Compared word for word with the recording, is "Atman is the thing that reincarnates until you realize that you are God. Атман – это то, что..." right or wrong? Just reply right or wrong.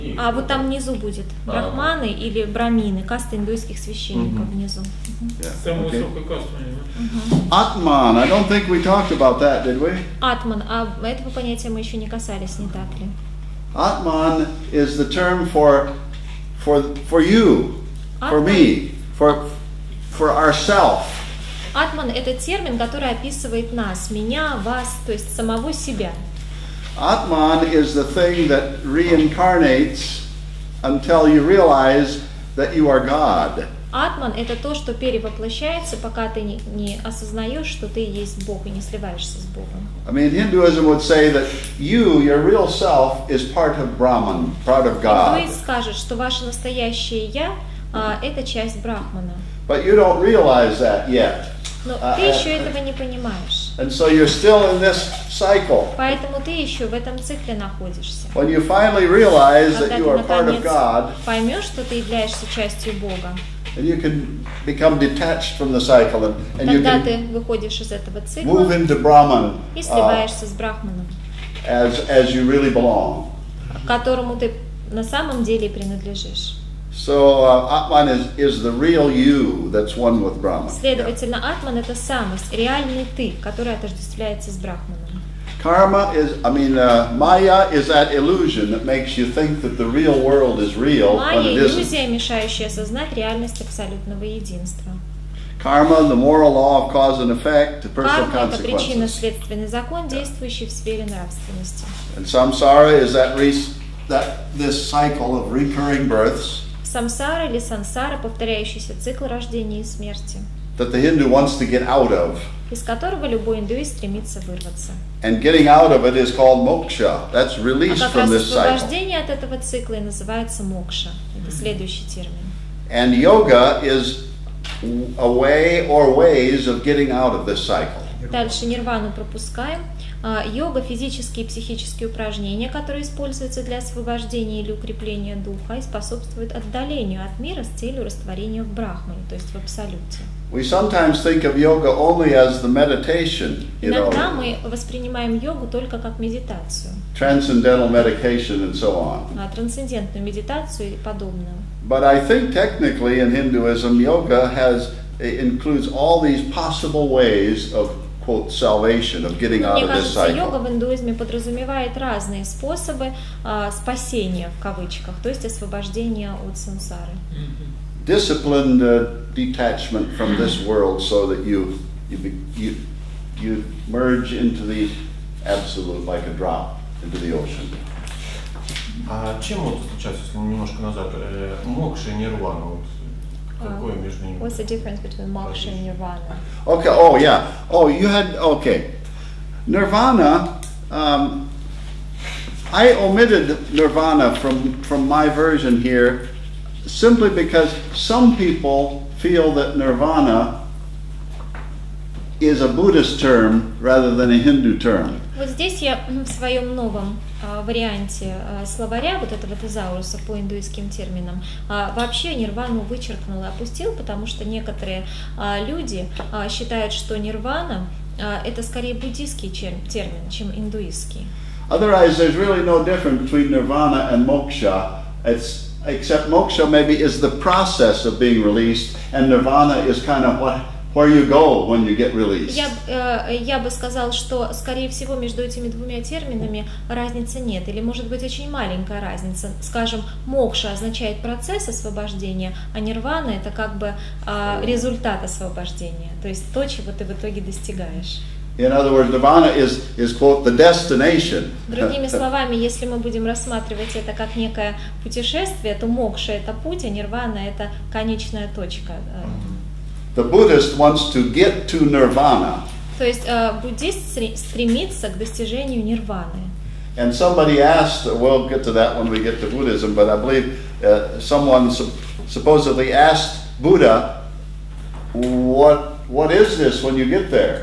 right.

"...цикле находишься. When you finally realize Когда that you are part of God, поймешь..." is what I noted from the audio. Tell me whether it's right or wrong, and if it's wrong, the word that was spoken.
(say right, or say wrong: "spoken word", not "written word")
right.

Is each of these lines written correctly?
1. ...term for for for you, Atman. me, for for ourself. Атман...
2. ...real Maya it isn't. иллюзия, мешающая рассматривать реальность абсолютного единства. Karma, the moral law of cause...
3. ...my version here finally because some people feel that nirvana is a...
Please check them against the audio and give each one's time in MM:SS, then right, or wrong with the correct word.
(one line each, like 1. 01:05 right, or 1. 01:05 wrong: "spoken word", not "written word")
1. 00:15 right
2. 01:30 wrong: "осознать", not "рассматривать"
3. 03:15 wrong: "simply", not "finally".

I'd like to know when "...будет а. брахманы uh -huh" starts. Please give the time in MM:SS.
00:00.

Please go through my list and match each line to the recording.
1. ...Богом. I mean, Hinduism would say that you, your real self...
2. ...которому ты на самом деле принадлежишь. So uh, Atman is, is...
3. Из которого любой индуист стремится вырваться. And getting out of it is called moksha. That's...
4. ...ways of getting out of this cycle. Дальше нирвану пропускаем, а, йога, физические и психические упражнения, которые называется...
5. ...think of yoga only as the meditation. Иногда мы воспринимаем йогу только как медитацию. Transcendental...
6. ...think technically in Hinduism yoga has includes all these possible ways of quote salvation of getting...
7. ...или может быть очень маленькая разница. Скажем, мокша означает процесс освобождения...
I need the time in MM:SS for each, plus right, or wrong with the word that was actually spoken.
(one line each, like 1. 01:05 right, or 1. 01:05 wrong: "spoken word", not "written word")
1. 00:39 right
2. 01:13 right
3. 01:52 right
4. 02:06 wrong: "используются", not "называется"
5. 02:21 right
6. 02:32 right
7. 03:57 right.